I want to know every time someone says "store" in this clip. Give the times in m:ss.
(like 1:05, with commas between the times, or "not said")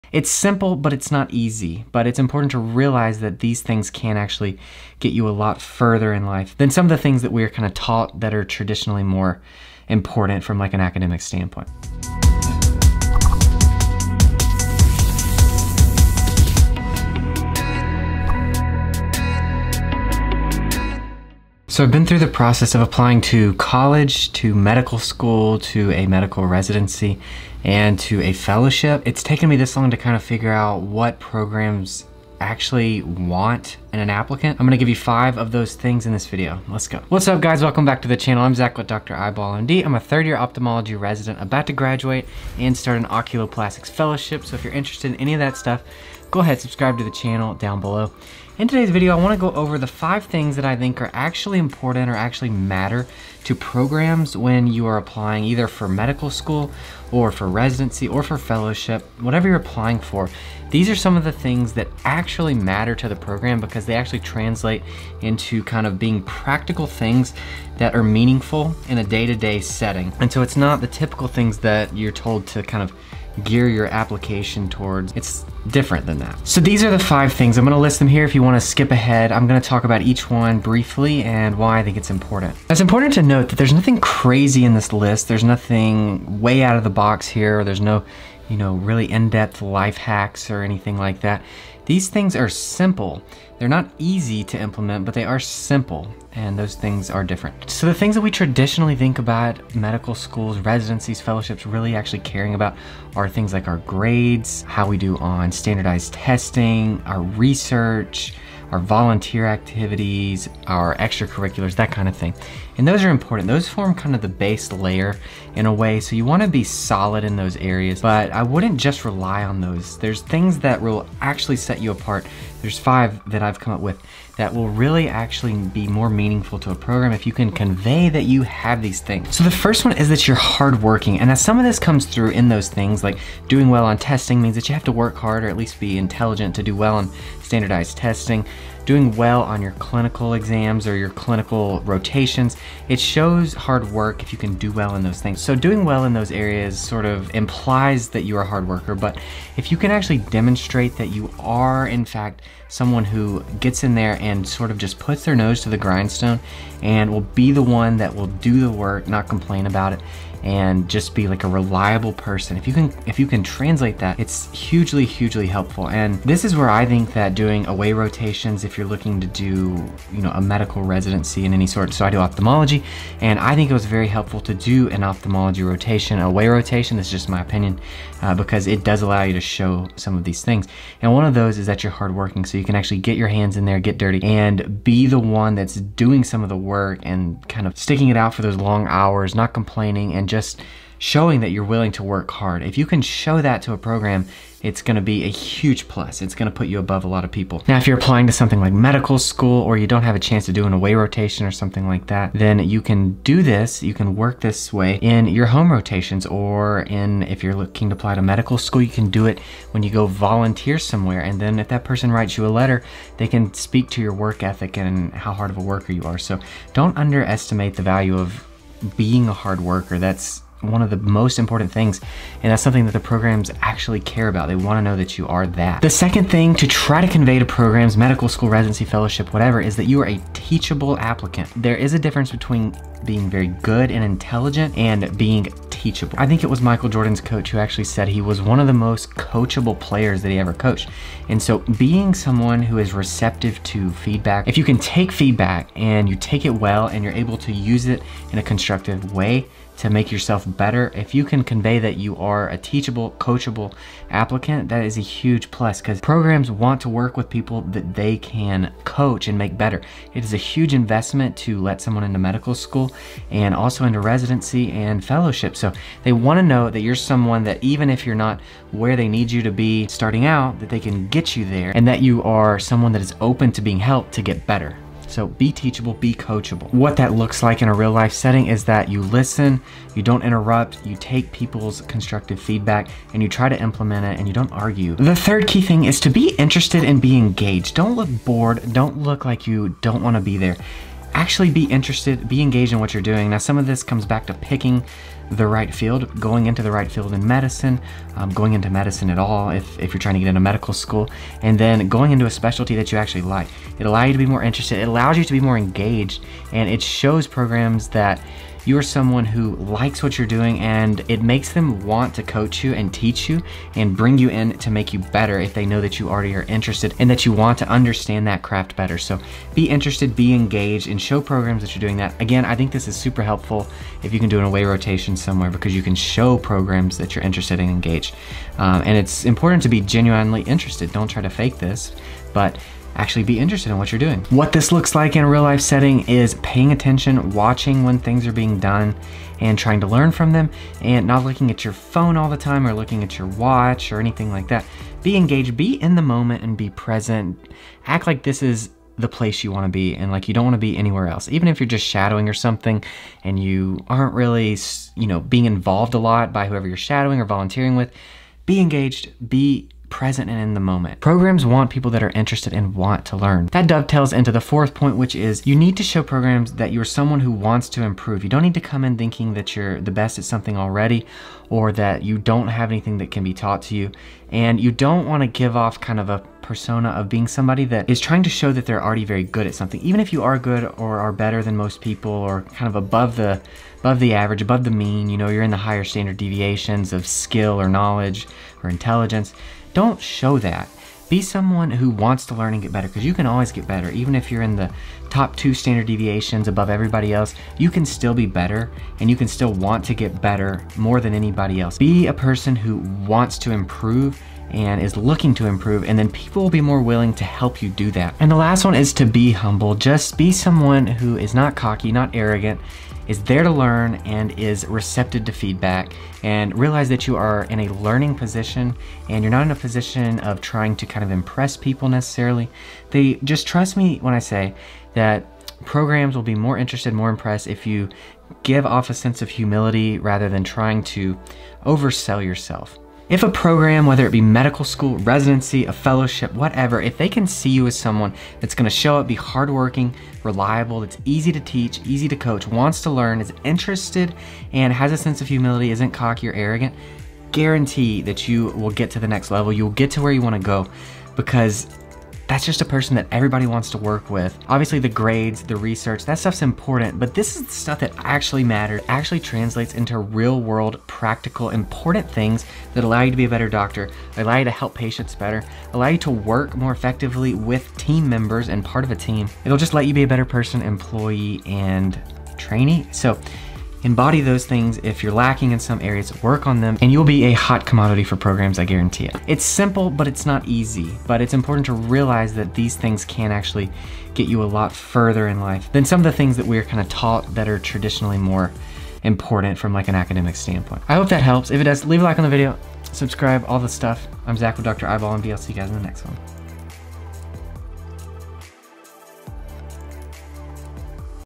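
not said.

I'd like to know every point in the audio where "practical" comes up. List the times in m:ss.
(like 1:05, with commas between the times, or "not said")
1:06, 7:40.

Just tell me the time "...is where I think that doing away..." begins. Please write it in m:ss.
2:46.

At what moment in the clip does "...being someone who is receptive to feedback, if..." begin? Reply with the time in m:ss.
4:01.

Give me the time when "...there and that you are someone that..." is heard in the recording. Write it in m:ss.
4:31.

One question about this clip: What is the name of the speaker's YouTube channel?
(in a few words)
Dr. Eyeball MD.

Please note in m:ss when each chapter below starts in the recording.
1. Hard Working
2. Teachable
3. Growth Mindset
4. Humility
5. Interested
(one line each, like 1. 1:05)
1. 2:10
2. 3:47
3. 6:04
4. 6:48
5. 4:46.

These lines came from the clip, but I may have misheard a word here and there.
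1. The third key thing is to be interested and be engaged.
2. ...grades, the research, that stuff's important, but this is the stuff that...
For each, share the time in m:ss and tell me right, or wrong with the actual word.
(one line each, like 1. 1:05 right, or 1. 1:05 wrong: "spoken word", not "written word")
1. 4:44 right
2. 7:34 right.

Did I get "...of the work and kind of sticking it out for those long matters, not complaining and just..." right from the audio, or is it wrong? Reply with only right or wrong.
wrong.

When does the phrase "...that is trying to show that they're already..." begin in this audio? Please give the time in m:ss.
6:17.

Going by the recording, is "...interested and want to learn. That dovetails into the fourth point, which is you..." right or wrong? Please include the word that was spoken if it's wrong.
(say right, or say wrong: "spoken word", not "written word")
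right.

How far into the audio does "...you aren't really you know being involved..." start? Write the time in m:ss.
5:53.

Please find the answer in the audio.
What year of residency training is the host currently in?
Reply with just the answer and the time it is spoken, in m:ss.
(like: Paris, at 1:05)
Third year, at 0:39.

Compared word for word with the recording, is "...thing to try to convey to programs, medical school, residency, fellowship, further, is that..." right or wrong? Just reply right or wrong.
wrong.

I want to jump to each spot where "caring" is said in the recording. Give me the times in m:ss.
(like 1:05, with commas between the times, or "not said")
1:42.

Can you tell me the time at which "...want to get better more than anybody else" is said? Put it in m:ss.
6:39.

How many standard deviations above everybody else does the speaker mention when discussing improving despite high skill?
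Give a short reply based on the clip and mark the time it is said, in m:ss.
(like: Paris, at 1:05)
2, at 6:35.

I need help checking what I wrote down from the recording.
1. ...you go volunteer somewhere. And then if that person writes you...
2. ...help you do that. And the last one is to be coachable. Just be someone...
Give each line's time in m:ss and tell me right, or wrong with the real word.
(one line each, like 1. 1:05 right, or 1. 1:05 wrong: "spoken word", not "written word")
1. 3:29 right
2. 6:47 wrong: "humble", not "coachable".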